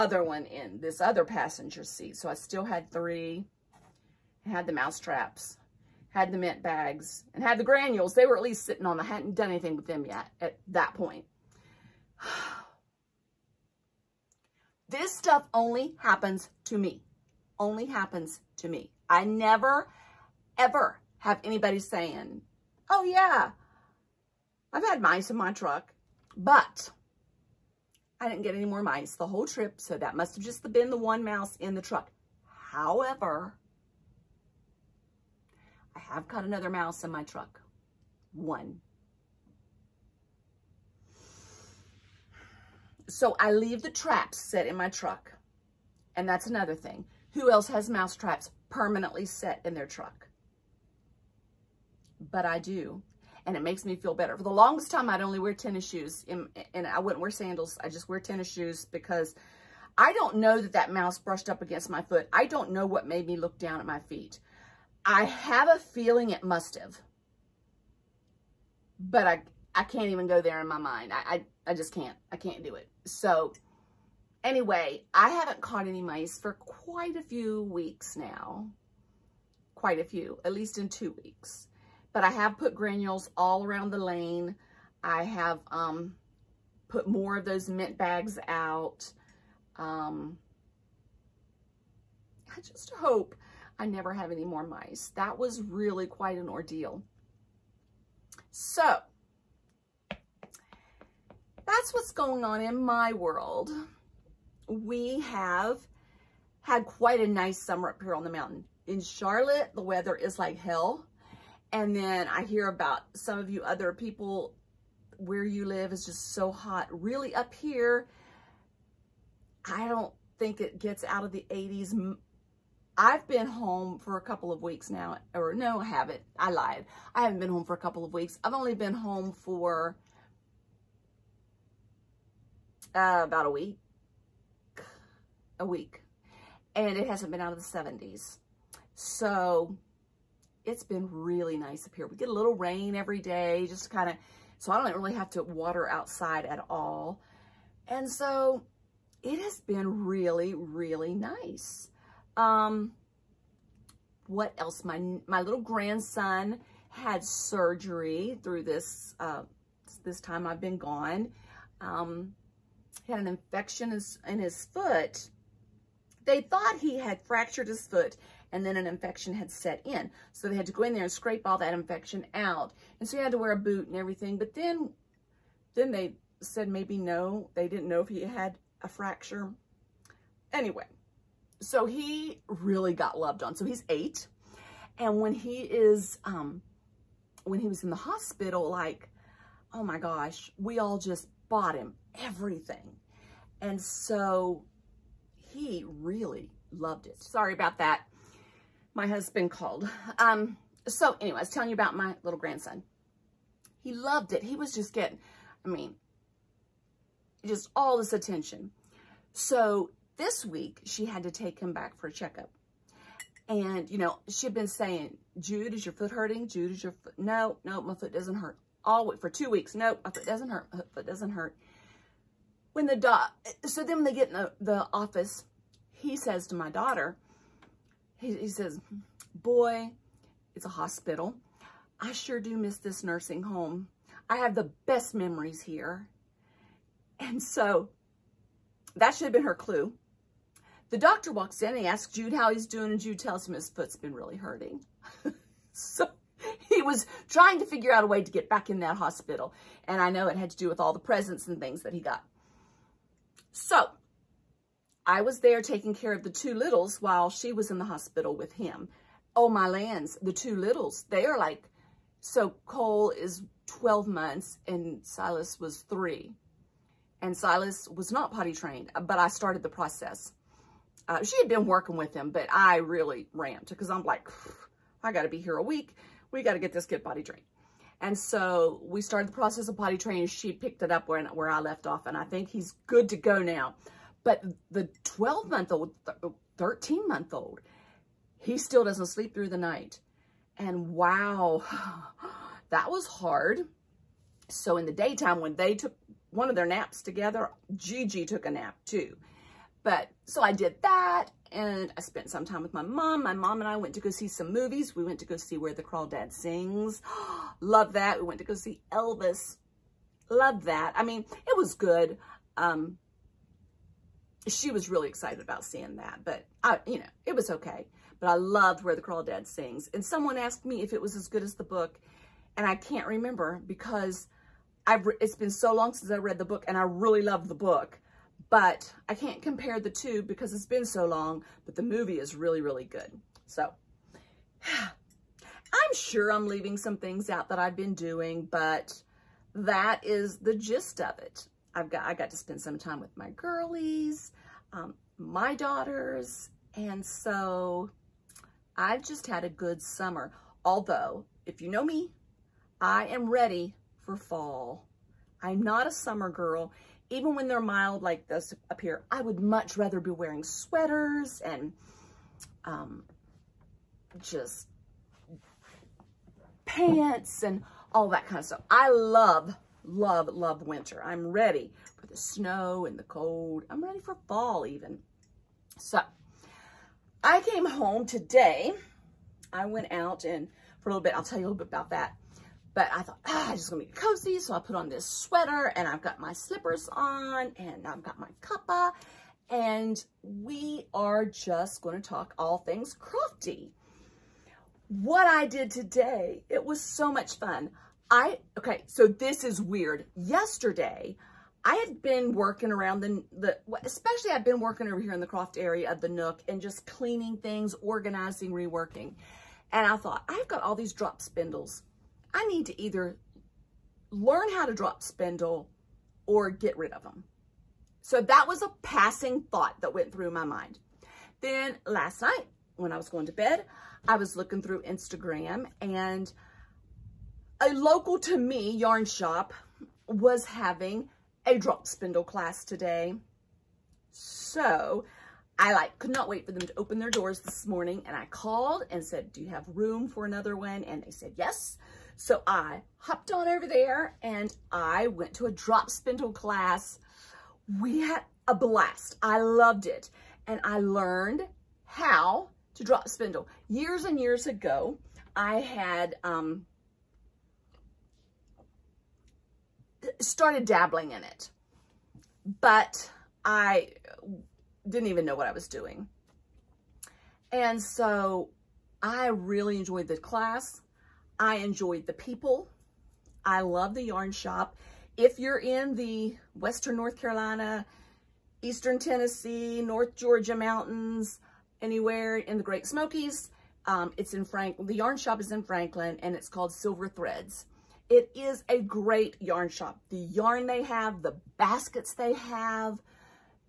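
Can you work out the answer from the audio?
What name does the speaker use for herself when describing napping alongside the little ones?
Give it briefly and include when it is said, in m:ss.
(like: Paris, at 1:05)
Gigi, at 4:57.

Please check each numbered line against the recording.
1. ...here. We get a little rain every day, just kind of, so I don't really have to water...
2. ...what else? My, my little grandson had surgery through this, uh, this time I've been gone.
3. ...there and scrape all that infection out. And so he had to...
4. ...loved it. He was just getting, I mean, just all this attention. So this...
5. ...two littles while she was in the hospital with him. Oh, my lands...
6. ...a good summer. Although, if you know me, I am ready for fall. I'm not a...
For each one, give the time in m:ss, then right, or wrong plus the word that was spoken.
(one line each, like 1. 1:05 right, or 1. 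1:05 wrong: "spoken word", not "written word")
1. 2:21 right
2. 2:34 right
3. 2:50 right
4. 3:23 right
5. 4:16 right
6. 5:49 right.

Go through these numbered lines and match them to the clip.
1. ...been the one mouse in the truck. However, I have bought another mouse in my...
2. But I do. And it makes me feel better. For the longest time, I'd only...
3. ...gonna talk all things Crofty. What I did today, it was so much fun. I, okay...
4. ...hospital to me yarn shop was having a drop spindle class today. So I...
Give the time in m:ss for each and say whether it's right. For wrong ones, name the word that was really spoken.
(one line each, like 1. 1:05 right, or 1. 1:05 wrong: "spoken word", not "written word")
1. 0:30 wrong: "caught", not "bought"
2. 0:52 right
3. 6:31 right
4. 7:07 wrong: "local", not "hospital".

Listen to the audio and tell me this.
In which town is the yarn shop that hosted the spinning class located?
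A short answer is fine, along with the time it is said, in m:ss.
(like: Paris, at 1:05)
Franklin, at 8:05.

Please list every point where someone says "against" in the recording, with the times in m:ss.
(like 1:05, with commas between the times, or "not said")
1:01.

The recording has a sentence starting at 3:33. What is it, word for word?
And, you know, she'd been saying, Jude, is your foot hurting?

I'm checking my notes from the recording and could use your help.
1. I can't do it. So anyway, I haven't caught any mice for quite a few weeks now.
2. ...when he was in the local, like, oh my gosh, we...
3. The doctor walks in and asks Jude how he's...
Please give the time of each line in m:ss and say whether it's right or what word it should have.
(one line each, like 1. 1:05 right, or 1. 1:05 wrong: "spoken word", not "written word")
1. 1:12 right
2. 3:07 wrong: "hospital", not "local"
3. 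4:00 right.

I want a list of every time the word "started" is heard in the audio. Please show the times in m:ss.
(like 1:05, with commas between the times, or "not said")
4:29, 4:39, 7:40.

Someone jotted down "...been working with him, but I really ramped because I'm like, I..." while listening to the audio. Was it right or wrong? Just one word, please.
right.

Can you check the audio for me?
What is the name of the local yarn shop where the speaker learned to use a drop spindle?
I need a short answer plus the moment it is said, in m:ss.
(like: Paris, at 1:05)
Silver Threads, at 8:06.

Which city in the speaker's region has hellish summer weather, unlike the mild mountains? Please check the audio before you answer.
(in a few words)
Charlotte.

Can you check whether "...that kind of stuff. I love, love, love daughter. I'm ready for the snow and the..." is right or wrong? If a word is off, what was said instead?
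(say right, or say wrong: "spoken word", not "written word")
wrong: "winter", not "daughter".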